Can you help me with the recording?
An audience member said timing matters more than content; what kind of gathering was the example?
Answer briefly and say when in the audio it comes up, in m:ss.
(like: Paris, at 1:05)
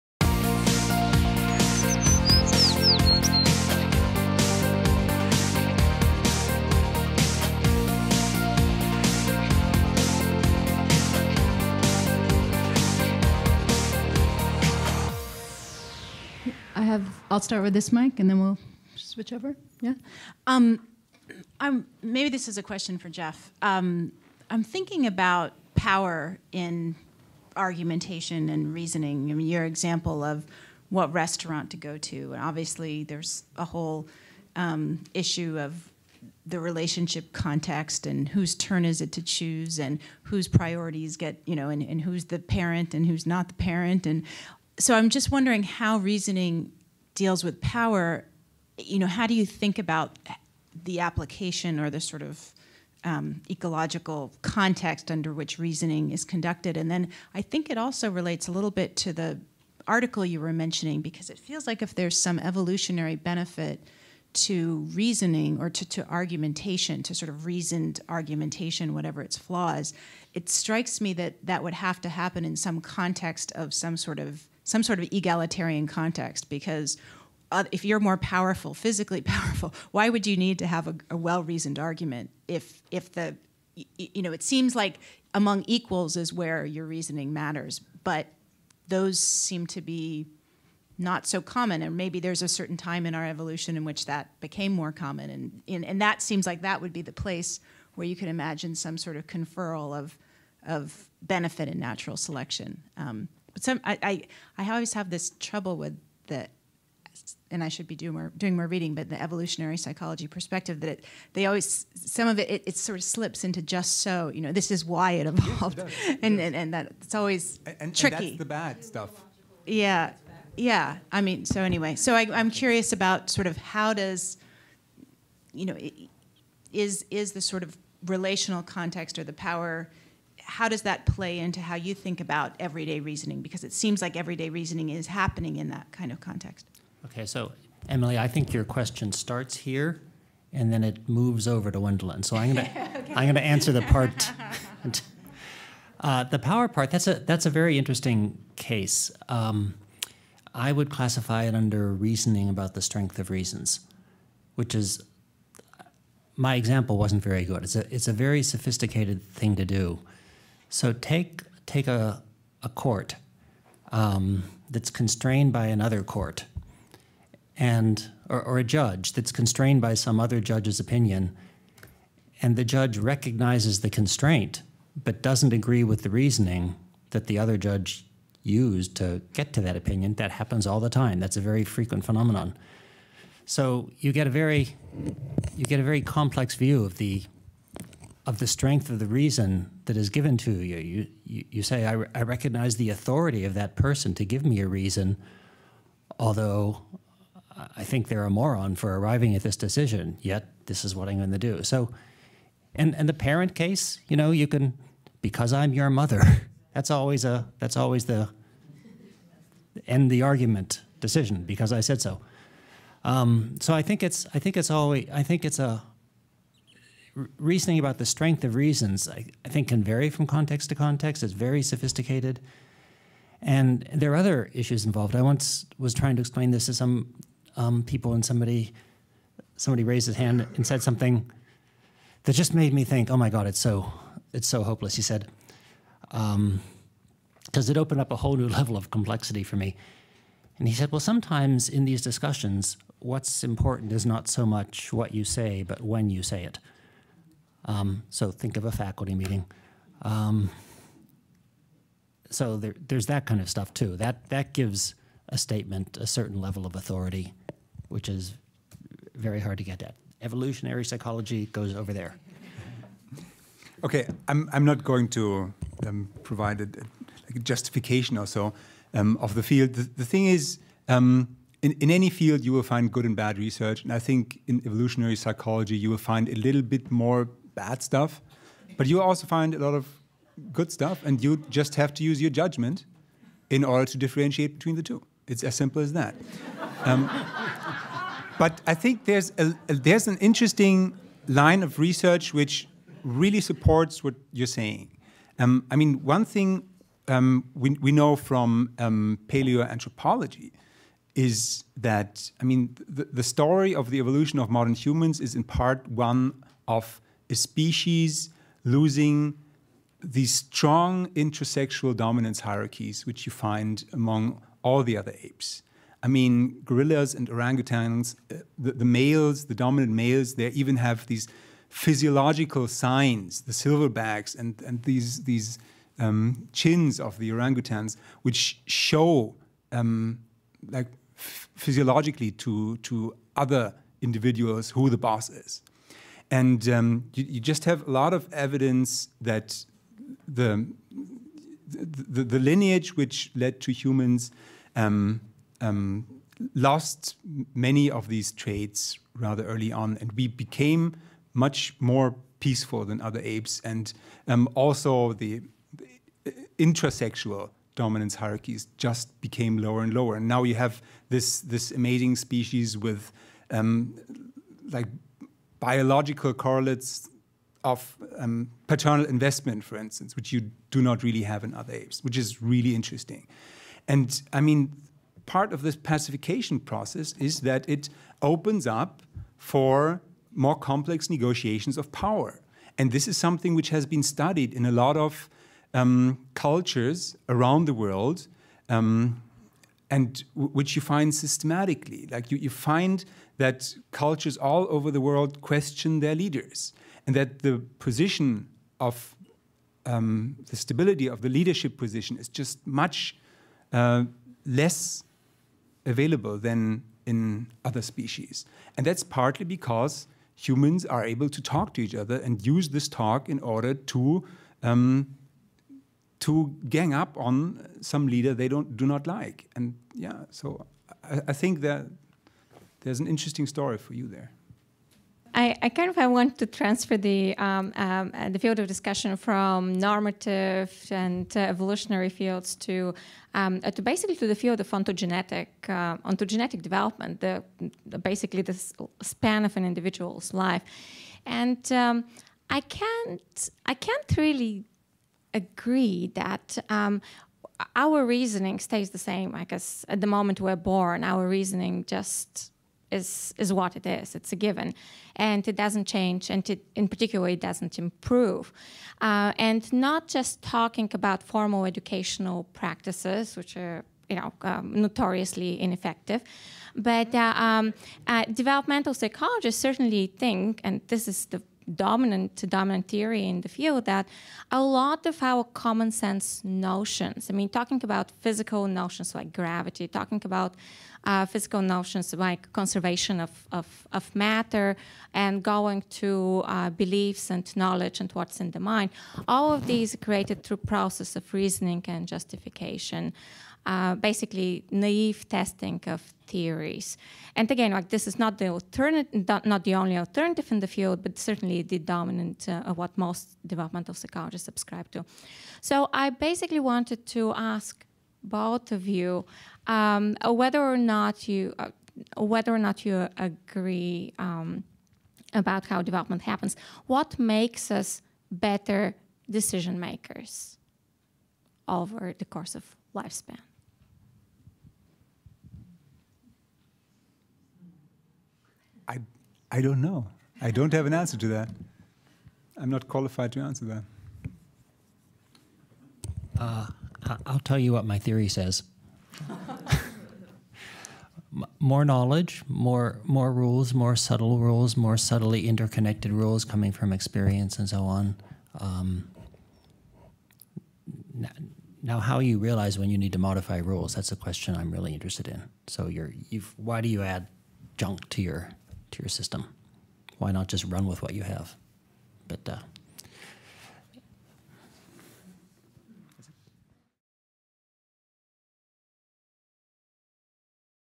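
A faculty meeting, at 4:08.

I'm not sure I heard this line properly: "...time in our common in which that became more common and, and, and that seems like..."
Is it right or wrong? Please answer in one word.
wrong.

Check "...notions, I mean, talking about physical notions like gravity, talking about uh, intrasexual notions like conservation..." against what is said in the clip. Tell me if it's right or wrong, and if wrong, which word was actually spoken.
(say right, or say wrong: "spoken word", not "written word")
wrong: "physical", not "intrasexual".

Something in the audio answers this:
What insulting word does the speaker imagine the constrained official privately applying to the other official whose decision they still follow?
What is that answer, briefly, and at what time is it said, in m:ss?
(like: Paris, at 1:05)
Moron, at 3:18.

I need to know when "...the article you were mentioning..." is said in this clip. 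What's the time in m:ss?
0:59.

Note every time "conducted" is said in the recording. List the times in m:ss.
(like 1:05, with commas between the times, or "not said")
0:56.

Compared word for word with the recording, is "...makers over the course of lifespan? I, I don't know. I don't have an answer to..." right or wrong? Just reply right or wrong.
right.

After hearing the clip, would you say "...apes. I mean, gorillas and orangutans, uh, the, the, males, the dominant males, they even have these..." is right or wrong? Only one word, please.
right.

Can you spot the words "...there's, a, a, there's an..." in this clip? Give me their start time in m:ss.
4:49.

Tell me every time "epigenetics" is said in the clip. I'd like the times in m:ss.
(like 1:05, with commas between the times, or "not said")
not said.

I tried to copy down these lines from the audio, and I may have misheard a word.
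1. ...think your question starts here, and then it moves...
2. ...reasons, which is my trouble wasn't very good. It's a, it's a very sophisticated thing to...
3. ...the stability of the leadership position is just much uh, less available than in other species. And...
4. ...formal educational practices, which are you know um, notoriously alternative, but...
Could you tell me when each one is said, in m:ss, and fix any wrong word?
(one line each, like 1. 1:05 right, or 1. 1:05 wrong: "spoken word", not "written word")
1. 2:18 right
2. 2:33 wrong: "example", not "trouble"
3. 6:40 right
4. 7:41 wrong: "ineffective", not "alternative".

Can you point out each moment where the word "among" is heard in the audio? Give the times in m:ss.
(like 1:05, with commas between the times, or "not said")
1:25, 5:13.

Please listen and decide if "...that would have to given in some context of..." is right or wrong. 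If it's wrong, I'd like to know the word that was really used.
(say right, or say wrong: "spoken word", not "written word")
wrong: "happen", not "given".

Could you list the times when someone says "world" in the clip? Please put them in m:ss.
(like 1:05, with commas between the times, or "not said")
6:27, 6:35.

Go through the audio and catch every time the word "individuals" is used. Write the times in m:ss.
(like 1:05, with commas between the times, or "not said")
5:34, 7:19.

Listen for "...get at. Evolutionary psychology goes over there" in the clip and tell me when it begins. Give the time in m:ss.
4:19.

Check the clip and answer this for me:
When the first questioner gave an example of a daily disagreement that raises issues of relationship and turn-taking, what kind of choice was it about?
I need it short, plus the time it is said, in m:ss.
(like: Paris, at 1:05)
What restaurant to go to, at 0:30.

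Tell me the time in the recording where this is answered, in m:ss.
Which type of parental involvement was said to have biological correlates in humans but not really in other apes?
6:08.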